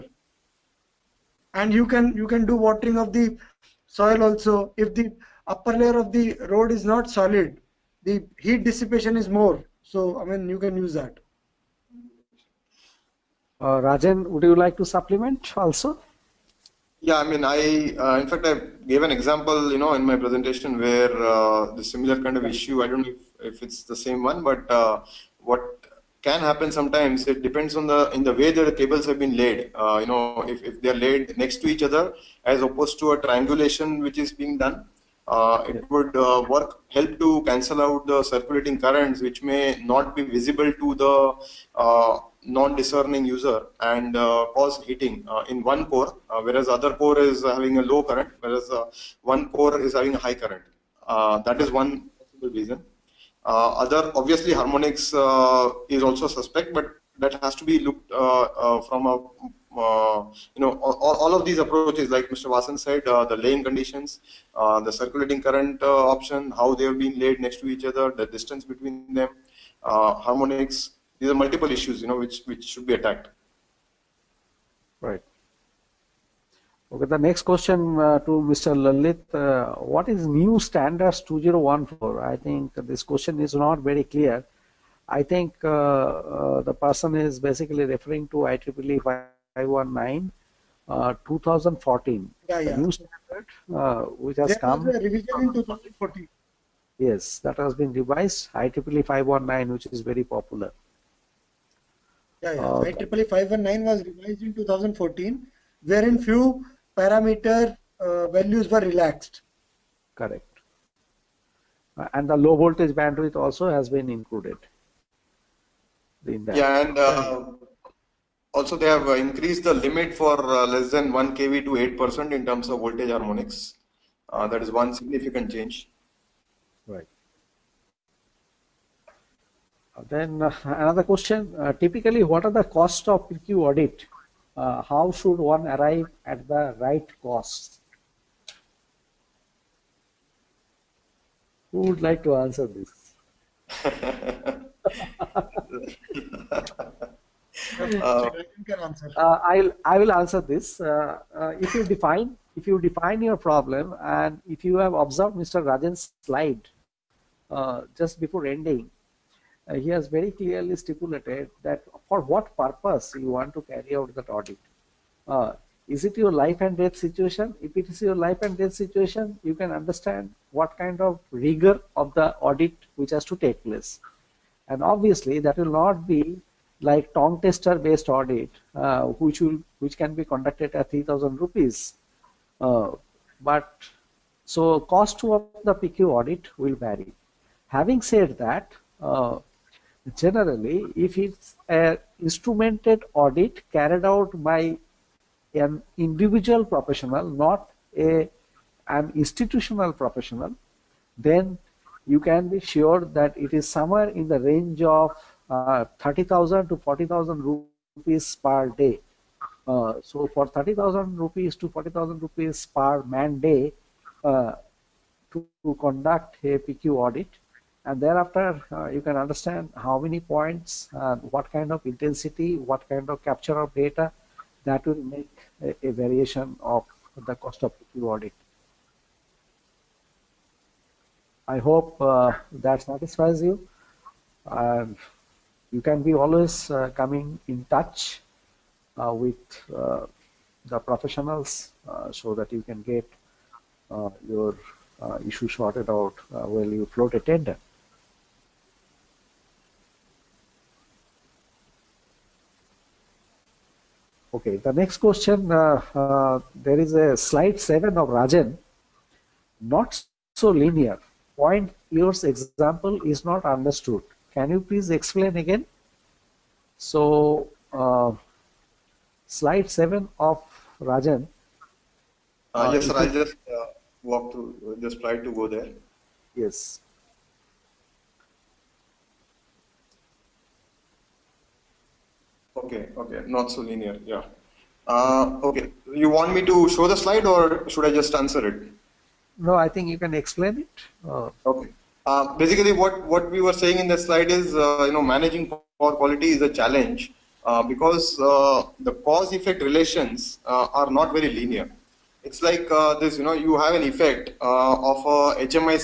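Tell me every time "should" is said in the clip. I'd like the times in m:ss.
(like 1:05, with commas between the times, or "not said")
1:12, 2:15, 4:47.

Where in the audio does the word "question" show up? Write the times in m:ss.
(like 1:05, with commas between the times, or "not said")
1:17, 1:23, 2:11, 4:14.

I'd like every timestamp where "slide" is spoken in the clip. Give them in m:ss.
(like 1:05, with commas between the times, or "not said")
2:36, 4:17, 4:29, 4:46, 4:53.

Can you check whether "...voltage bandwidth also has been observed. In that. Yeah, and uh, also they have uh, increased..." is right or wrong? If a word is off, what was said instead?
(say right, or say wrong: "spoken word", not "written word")
wrong: "included", not "observed".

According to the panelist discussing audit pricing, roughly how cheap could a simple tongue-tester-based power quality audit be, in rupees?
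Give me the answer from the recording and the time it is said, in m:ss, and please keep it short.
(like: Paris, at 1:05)
3,000 rupees, at 3:00.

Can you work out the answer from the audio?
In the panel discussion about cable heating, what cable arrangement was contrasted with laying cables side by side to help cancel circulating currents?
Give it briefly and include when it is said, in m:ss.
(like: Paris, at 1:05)
triangulation, at 0:33.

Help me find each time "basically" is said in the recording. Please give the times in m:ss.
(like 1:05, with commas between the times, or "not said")
1:27, 4:52.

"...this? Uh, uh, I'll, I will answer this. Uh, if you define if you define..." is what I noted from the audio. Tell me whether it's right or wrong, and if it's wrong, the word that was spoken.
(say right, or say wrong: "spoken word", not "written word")
right.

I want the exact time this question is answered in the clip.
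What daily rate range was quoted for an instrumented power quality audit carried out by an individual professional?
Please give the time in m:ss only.
3:25.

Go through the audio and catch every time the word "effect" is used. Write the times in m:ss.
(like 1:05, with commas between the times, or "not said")
4:58, 5:03.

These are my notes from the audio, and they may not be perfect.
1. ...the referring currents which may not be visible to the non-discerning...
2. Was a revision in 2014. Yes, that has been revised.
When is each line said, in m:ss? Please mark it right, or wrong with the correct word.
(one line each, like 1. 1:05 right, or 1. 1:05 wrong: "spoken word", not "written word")
1. 0:38 wrong: "circulating", not "referring"
2. 1:34 right.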